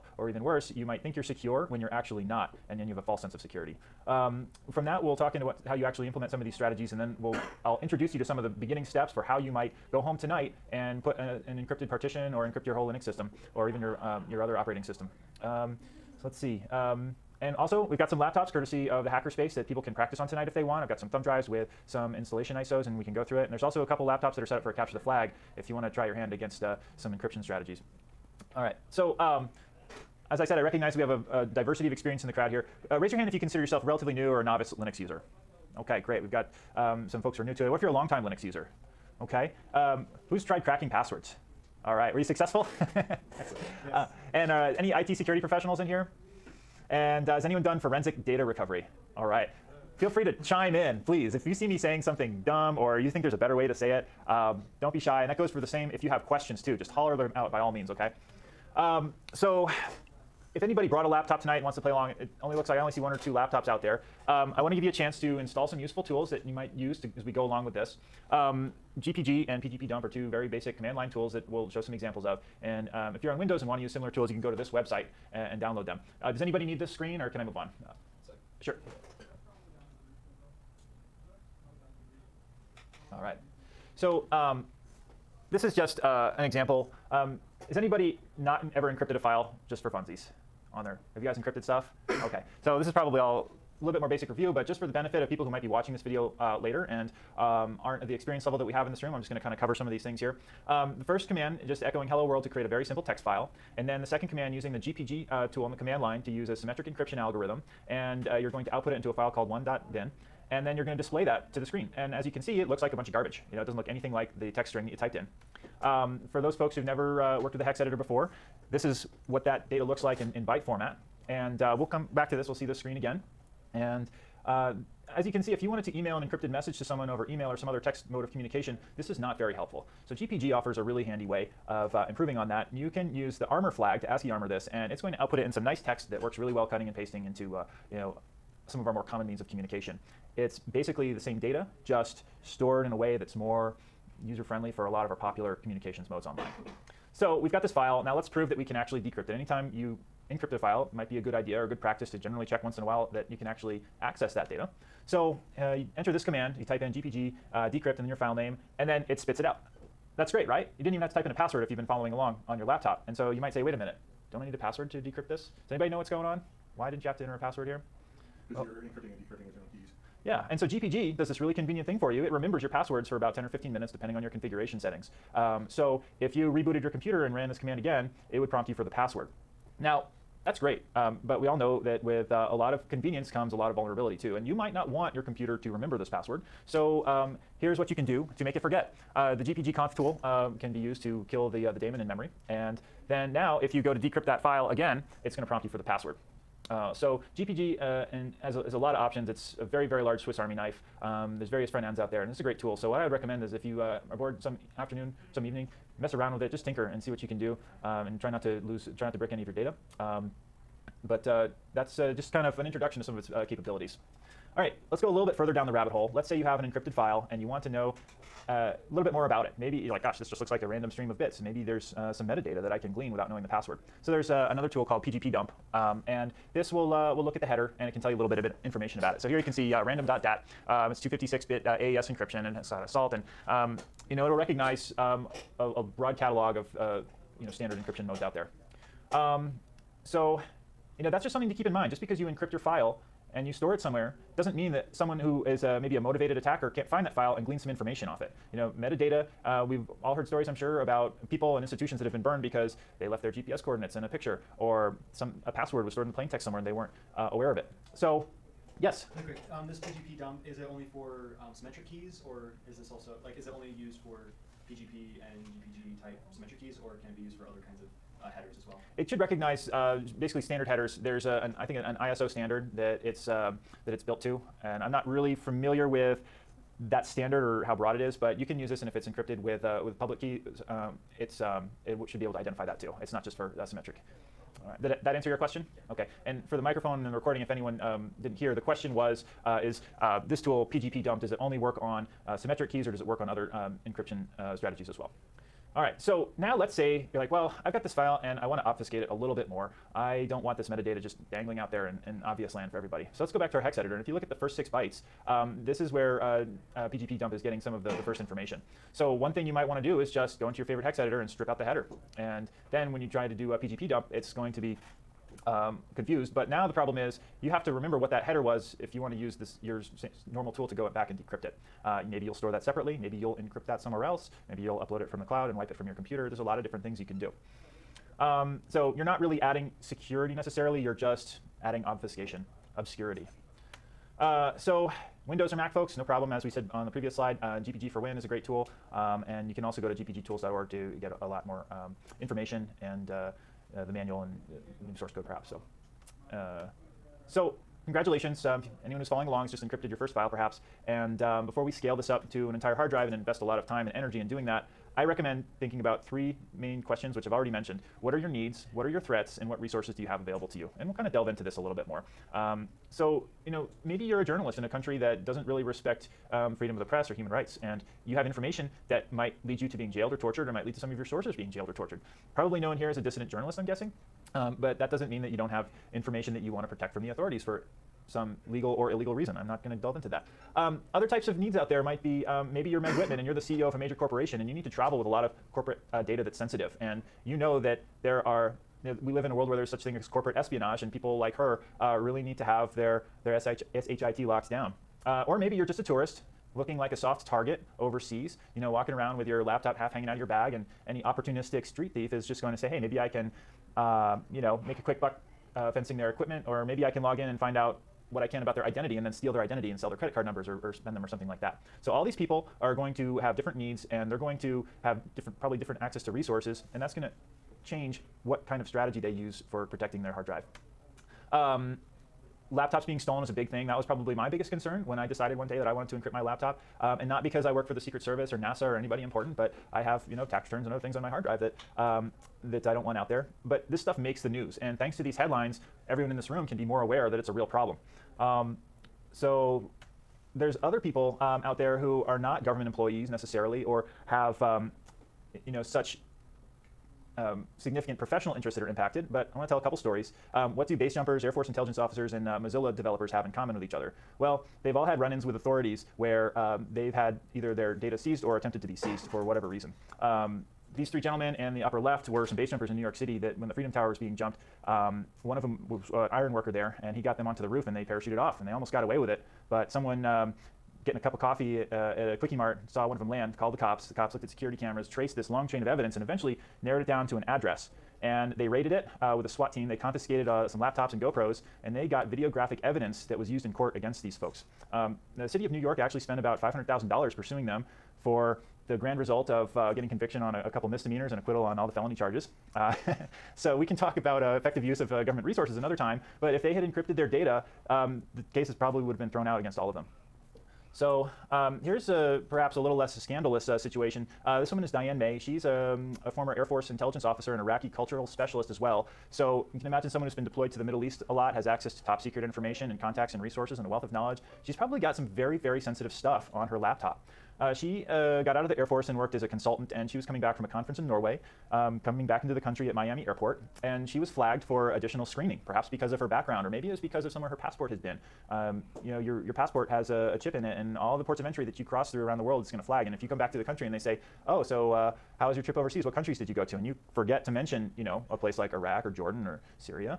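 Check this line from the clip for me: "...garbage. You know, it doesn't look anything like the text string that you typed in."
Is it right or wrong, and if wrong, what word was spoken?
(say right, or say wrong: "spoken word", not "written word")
right.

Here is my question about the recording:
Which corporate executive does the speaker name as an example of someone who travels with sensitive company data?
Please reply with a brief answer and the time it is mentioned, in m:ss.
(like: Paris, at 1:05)
Meg Whitman, at 6:22.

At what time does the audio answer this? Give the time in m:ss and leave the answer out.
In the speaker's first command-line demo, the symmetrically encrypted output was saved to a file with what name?
1:49.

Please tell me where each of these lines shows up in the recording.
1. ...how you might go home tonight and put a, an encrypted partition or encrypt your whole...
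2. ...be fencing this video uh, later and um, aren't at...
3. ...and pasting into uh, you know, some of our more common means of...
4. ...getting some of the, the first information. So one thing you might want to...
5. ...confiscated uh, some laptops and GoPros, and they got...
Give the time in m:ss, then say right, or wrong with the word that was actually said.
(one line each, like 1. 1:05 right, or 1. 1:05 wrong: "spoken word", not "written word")
1. 0:09 right
2. 1:35 wrong: "watching", not "fencing"
3. 2:16 right
4. 5:07 right
5. 7:59 right.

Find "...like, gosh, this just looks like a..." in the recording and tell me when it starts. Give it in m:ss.
3:39.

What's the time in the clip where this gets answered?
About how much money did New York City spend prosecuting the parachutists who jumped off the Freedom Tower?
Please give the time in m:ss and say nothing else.
8:06.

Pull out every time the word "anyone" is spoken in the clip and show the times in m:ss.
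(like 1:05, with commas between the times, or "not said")
0:47, 4:47, 5:48.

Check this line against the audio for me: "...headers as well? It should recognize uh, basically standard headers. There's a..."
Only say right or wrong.
right.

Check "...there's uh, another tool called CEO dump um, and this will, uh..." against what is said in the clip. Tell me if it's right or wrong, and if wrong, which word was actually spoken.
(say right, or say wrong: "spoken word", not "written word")
wrong: "PGP", not "CEO".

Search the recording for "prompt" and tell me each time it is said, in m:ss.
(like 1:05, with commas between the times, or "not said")
2:58, 3:15.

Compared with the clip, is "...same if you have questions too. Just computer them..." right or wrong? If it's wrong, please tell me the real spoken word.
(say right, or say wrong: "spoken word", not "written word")
wrong: "holler", not "computer".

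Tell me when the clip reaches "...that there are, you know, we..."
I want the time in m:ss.
6:27.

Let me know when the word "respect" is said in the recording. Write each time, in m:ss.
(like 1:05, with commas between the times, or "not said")
6:05.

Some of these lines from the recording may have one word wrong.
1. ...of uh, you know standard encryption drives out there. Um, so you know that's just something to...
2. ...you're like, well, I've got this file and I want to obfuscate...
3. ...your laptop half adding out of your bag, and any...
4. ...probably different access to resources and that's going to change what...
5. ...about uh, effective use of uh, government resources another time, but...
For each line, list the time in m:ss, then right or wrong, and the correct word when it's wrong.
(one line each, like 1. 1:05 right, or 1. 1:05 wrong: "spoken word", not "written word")
1. 3:56 wrong: "modes", not "drives"
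2. 4:57 right
3. 6:39 wrong: "hanging", not "adding"
4. 6:55 right
5. 8:13 right.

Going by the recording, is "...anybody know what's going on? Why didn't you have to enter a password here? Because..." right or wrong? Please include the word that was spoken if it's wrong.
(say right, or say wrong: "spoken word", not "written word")
right.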